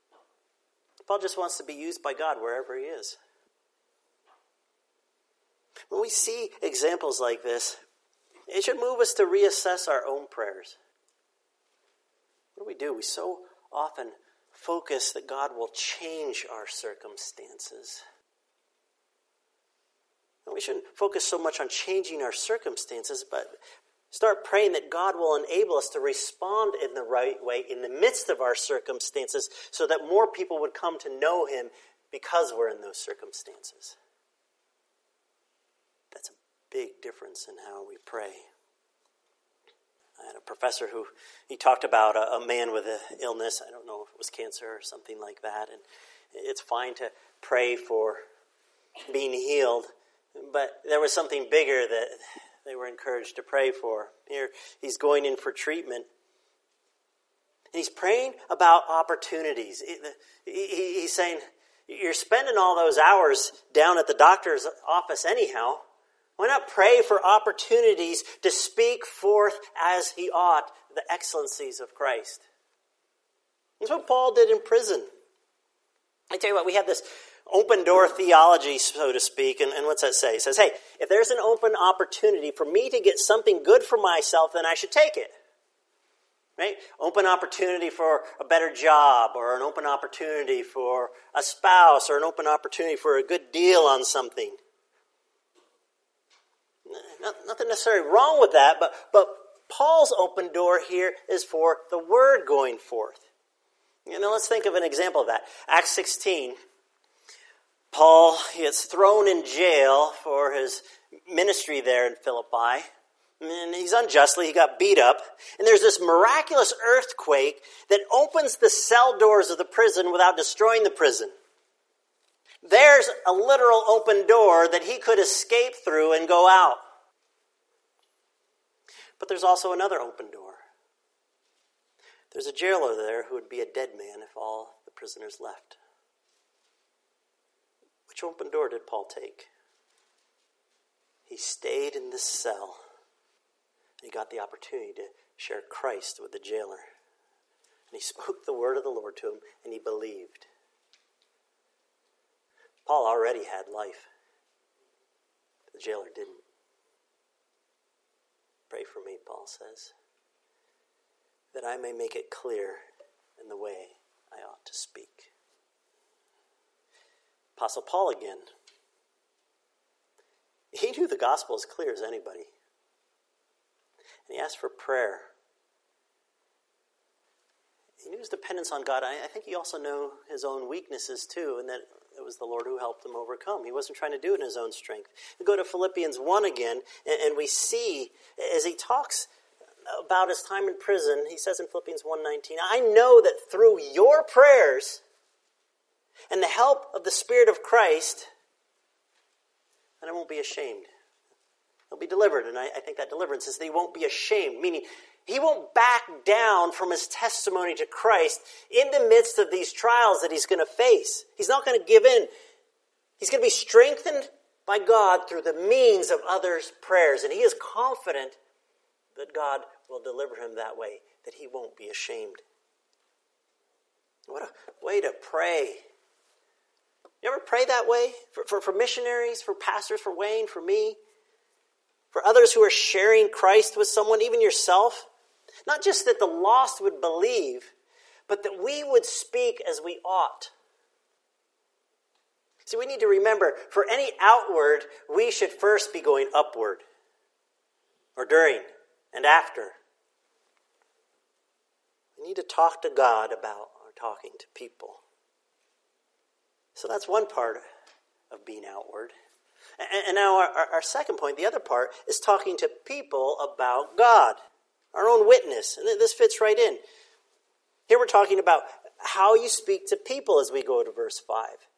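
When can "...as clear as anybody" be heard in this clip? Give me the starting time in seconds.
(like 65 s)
171 s.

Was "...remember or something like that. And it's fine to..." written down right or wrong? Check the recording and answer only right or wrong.
wrong.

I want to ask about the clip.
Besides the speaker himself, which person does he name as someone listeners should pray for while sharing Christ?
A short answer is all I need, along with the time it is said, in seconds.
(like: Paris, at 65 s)
Wayne, at 230 s.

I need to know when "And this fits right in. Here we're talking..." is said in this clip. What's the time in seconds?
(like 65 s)
265 s.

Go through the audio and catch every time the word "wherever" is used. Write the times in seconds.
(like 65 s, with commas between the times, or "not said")
2 s.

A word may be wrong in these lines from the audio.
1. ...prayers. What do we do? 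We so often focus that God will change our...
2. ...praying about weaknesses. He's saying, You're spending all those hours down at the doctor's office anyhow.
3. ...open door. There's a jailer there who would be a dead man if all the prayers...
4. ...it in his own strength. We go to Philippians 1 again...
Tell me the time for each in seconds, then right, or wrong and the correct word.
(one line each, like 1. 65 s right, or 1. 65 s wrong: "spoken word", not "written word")
1. 10 s right
2. 57 s wrong: "opportunities", not "weaknesses"
3. 130 s wrong: "prisoners", not "prayers"
4. 184 s right.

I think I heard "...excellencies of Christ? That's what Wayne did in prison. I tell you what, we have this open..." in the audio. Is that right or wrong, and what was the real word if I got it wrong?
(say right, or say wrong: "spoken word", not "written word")
wrong: "Paul", not "Wayne".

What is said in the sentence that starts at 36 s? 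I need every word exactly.
That's a big difference in how we pray.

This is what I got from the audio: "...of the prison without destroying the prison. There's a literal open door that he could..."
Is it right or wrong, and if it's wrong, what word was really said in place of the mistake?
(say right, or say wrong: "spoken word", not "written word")
right.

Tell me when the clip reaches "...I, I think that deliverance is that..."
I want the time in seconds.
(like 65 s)
202 s.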